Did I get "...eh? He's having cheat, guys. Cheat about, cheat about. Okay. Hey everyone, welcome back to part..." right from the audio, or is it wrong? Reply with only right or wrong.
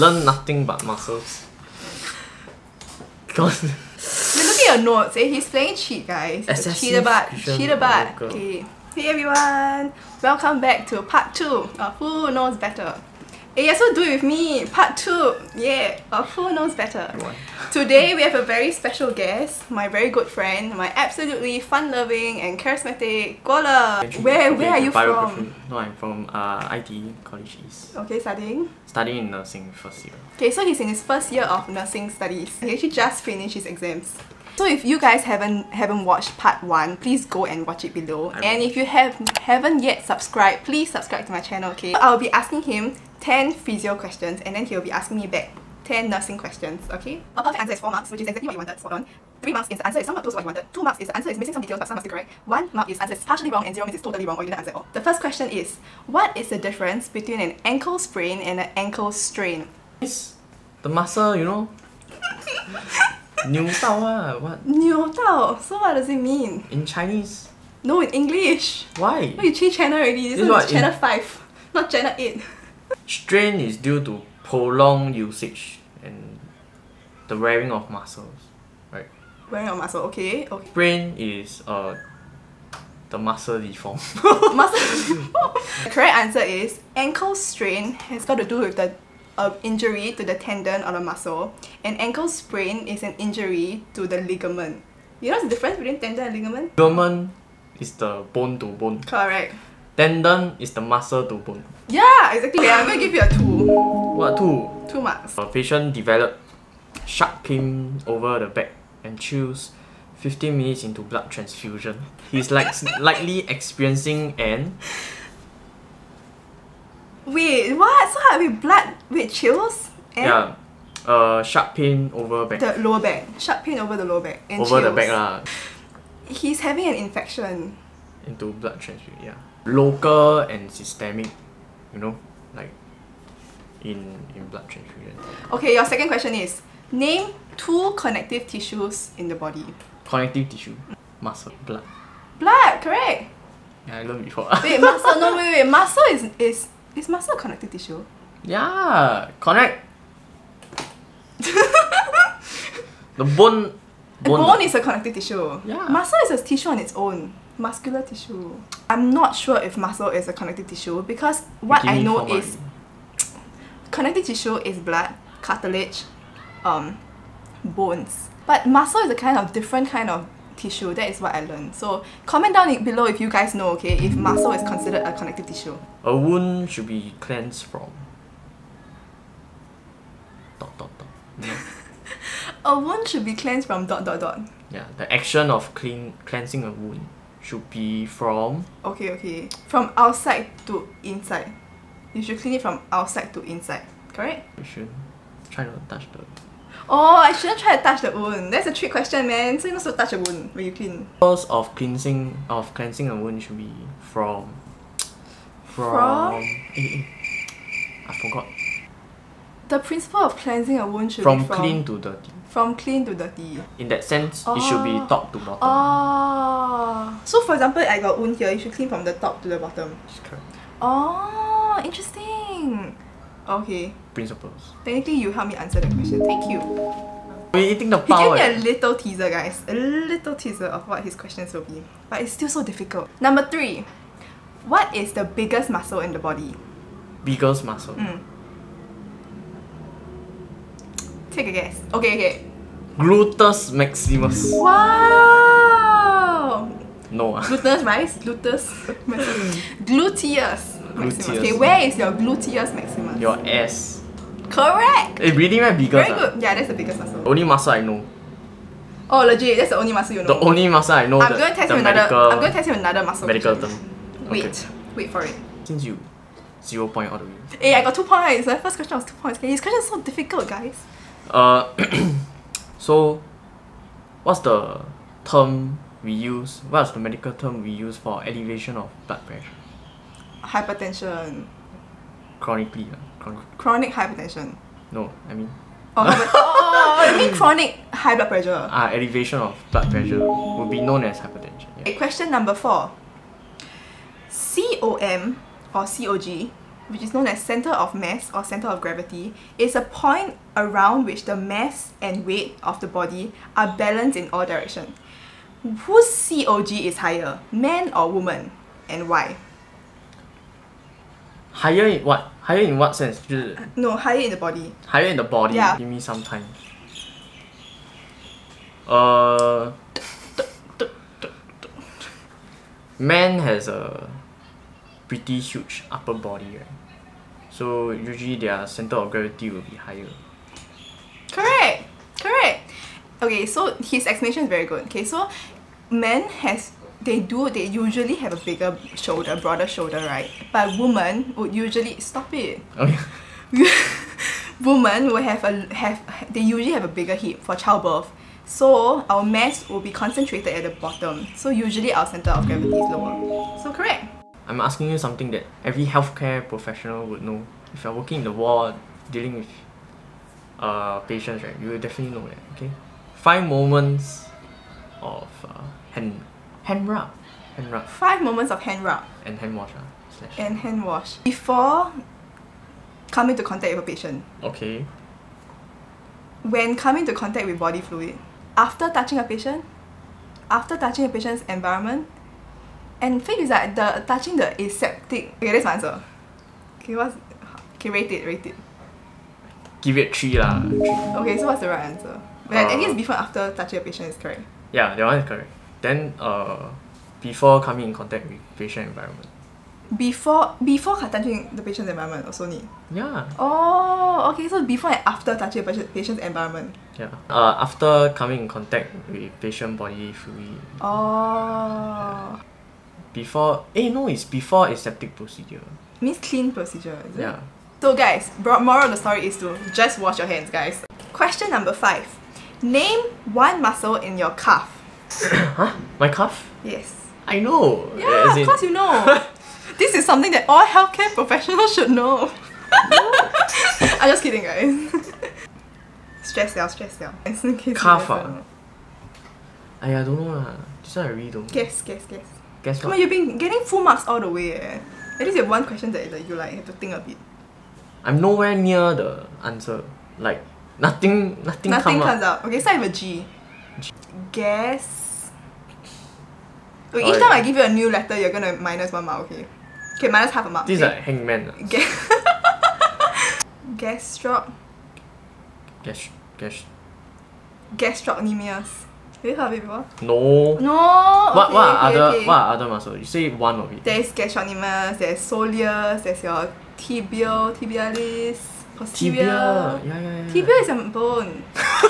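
wrong.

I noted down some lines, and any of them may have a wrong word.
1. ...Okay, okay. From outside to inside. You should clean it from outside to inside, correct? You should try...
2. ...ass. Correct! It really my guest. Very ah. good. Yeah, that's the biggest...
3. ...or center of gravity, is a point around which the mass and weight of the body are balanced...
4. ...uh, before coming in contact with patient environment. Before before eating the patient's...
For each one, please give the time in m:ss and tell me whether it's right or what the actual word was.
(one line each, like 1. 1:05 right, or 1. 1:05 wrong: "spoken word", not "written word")
1. 3:08 right
2. 4:13 wrong: "biggest", not "guest"
3. 4:58 right
4. 6:36 wrong: "touching", not "eating".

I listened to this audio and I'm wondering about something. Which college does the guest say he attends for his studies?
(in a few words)
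ITE College East.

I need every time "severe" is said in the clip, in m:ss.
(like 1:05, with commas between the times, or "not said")
not said.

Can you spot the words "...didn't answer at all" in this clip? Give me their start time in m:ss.
0:54.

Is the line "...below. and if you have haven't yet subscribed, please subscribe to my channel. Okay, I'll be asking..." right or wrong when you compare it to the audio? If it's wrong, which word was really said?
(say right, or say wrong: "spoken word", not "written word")
right.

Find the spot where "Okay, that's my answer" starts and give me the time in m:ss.
6:25.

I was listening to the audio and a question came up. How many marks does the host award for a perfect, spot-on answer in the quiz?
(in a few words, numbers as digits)
4.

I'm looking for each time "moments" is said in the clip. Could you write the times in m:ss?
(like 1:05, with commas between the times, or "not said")
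6:03, 6:08.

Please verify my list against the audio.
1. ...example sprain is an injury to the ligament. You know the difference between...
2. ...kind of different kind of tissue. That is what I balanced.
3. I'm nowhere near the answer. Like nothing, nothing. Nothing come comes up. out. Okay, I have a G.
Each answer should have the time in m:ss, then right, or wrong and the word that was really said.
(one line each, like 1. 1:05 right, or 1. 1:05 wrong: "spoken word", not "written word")
1. 1:32 wrong: "ankle", not "example"
2. 2:49 wrong: "learned", not "balanced"
3. 7:28 right.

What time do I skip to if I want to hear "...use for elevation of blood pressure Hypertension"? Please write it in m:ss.
4:37.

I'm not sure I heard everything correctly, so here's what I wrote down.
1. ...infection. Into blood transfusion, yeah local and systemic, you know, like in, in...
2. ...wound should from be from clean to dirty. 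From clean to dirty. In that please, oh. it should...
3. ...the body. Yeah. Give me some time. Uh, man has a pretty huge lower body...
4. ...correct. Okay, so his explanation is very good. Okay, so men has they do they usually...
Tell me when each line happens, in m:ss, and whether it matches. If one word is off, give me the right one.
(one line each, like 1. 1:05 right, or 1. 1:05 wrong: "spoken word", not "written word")
1. 2:06 right
2. 3:30 wrong: "sense", not "please"
3. 5:15 wrong: "upper", not "lower"
4. 5:32 right.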